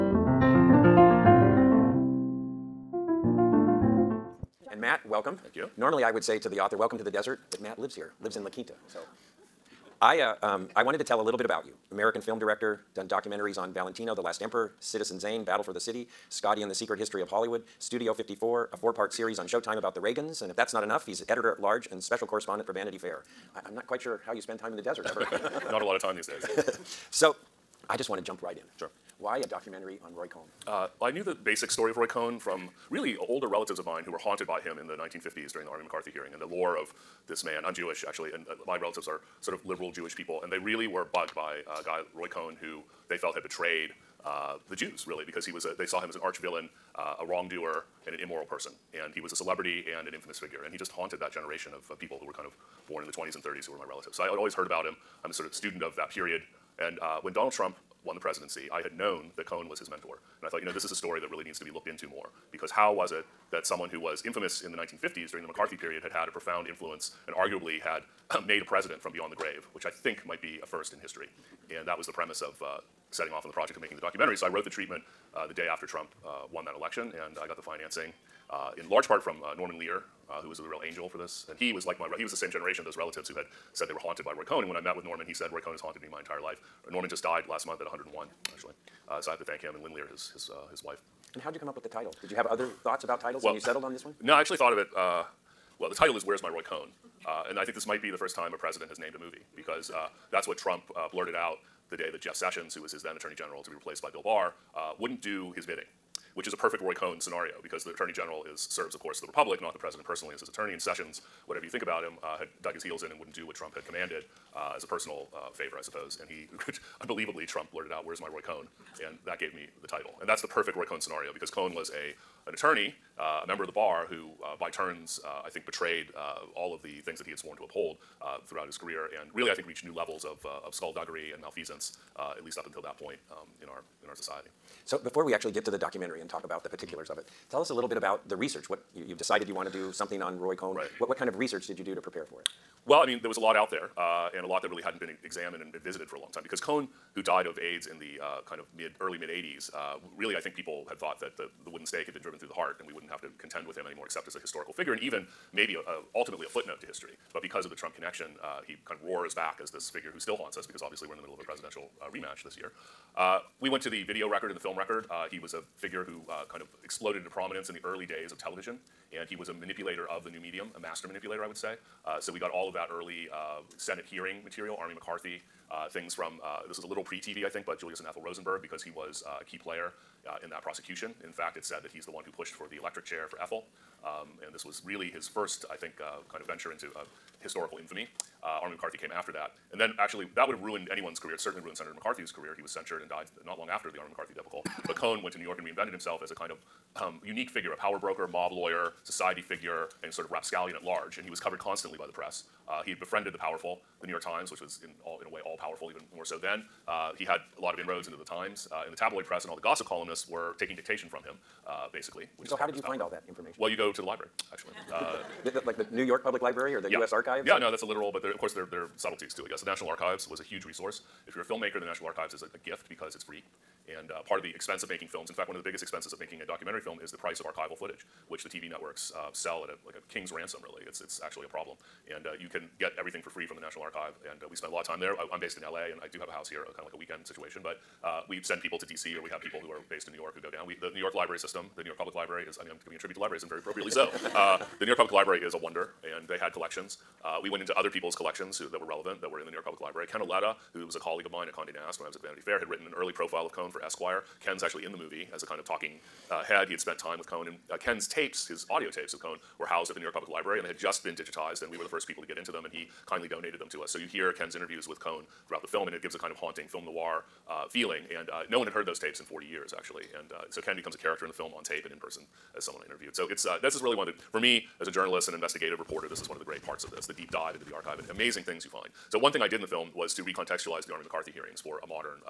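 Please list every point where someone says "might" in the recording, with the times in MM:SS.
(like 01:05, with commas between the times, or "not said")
01:10, 01:37.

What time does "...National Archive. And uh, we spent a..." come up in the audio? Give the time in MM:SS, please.
03:53.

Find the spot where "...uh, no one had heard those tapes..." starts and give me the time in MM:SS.
04:28.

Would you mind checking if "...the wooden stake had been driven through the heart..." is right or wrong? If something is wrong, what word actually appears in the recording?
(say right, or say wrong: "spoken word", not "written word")
right.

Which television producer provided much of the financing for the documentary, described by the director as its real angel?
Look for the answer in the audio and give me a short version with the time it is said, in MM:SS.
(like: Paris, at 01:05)
Norman Lear, at 01:19.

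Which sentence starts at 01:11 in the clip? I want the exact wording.
And that was the premise of uh, setting off on the project of making the documentary.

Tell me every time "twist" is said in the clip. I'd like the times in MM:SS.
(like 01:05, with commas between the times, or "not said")
not said.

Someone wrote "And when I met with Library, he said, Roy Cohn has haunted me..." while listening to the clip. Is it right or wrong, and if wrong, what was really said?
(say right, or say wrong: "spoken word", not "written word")
wrong: "Norman", not "Library".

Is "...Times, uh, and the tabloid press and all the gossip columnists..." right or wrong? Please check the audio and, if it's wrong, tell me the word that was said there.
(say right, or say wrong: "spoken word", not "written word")
right.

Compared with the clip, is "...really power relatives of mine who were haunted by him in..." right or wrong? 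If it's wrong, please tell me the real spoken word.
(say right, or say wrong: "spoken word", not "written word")
wrong: "older", not "power".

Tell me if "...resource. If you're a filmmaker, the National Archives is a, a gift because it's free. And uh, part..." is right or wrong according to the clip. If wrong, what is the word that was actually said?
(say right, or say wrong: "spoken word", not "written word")
right.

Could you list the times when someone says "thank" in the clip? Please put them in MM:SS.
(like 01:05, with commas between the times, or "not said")
00:05, 01:29.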